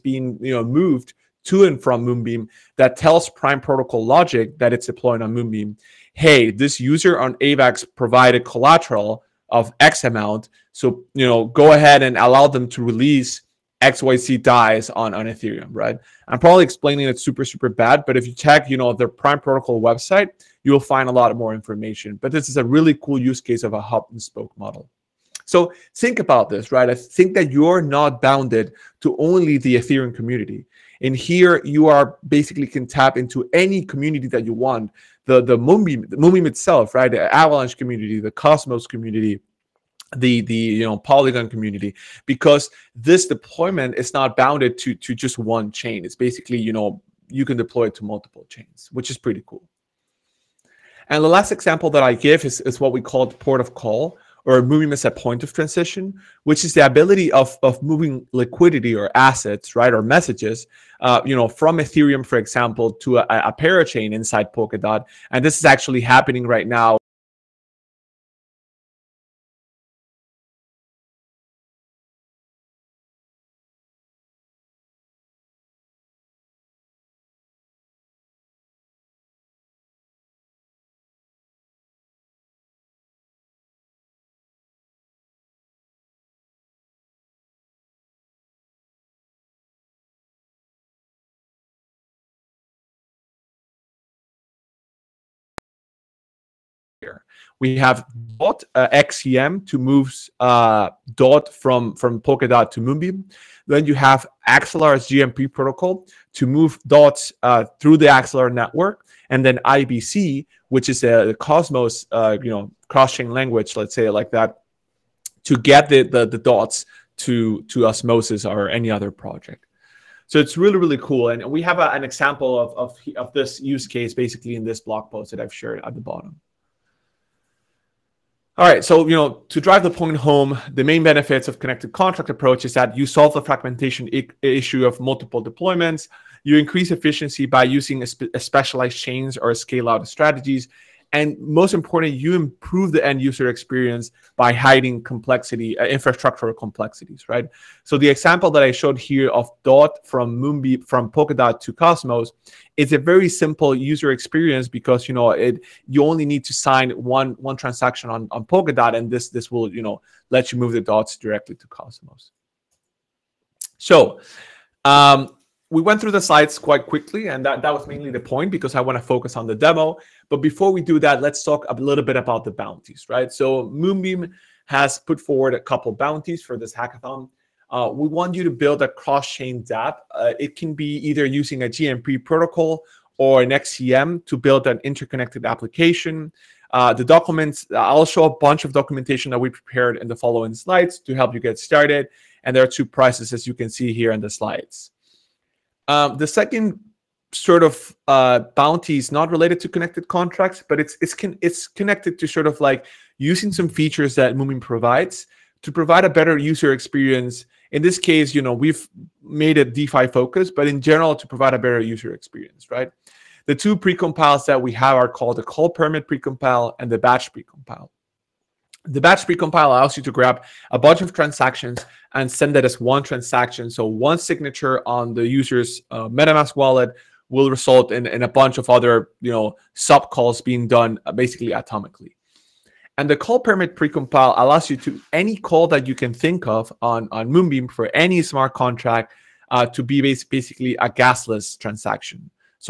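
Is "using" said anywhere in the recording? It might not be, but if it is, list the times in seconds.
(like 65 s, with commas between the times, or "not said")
137 s, 181 s, 203 s.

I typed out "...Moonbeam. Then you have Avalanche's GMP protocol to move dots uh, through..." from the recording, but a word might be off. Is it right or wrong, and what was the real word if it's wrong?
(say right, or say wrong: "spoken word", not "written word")
wrong: "Axelar", not "Avalanche".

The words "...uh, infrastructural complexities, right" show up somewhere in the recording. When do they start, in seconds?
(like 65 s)
145 s.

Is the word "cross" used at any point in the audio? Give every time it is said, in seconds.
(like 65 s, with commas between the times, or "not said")
112 s, 178 s.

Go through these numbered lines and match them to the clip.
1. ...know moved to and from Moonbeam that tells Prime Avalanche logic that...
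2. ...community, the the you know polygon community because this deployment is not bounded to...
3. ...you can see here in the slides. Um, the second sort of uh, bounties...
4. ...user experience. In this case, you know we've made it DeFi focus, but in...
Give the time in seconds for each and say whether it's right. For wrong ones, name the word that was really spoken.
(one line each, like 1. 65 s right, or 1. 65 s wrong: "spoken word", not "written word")
1. 0 s wrong: "Protocol", not "Avalanche"
2. 38 s right
3. 193 s right
4. 206 s right.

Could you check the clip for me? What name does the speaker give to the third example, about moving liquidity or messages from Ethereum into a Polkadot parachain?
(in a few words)
port of call.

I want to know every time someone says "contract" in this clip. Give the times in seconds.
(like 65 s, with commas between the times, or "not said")
131 s, 200 s, 238 s.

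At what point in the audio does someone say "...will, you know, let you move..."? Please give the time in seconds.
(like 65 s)
159 s.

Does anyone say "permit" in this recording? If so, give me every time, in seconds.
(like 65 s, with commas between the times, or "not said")
215 s, 233 s.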